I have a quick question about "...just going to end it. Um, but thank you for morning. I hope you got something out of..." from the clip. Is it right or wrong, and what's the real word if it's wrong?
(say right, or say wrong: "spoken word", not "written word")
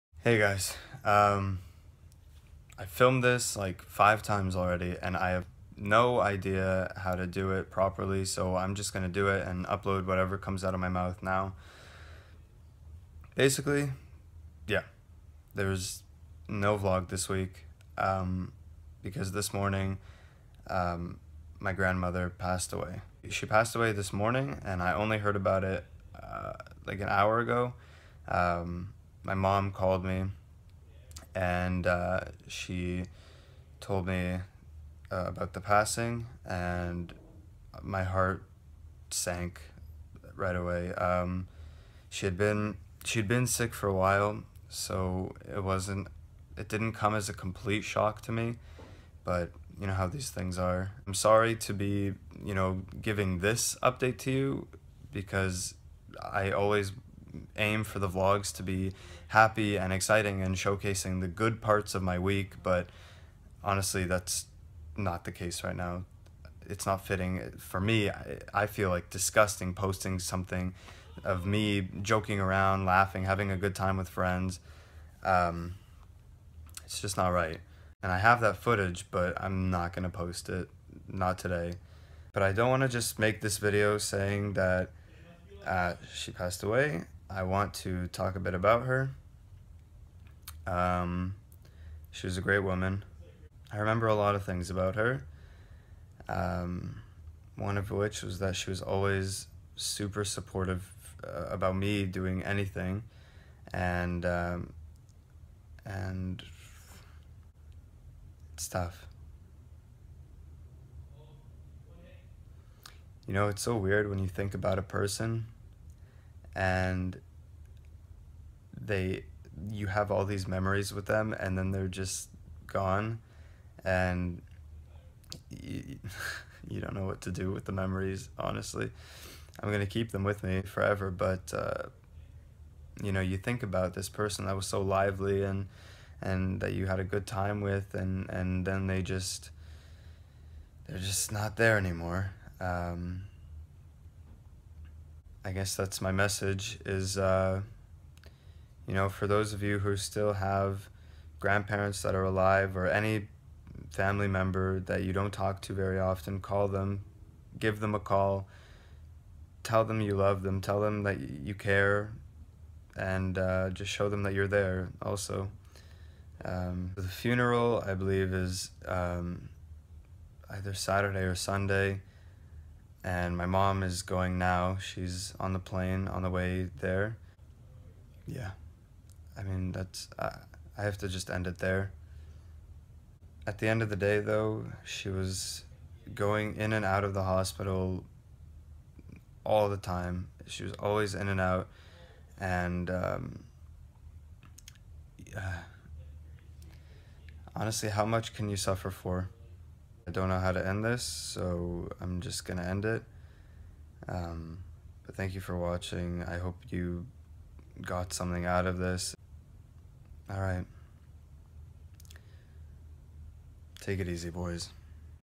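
wrong: "watching", not "morning".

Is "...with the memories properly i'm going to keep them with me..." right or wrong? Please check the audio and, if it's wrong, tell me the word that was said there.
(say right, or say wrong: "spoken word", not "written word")
wrong: "honestly", not "properly".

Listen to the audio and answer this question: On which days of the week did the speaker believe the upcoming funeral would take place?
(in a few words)
Saturday or Sunday.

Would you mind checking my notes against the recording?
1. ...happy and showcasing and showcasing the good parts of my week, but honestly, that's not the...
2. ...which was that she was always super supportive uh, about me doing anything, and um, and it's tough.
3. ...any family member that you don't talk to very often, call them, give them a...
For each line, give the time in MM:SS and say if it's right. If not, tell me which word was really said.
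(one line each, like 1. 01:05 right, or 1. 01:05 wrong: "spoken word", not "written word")
1. 00:59 wrong: "exciting", not "showcasing"
2. 01:37 right
3. 02:32 right.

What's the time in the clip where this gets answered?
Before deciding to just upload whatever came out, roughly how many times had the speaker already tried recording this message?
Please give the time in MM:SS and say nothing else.
00:03.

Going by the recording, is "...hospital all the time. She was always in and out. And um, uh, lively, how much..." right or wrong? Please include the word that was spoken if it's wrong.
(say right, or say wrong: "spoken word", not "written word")
wrong: "honestly", not "lively".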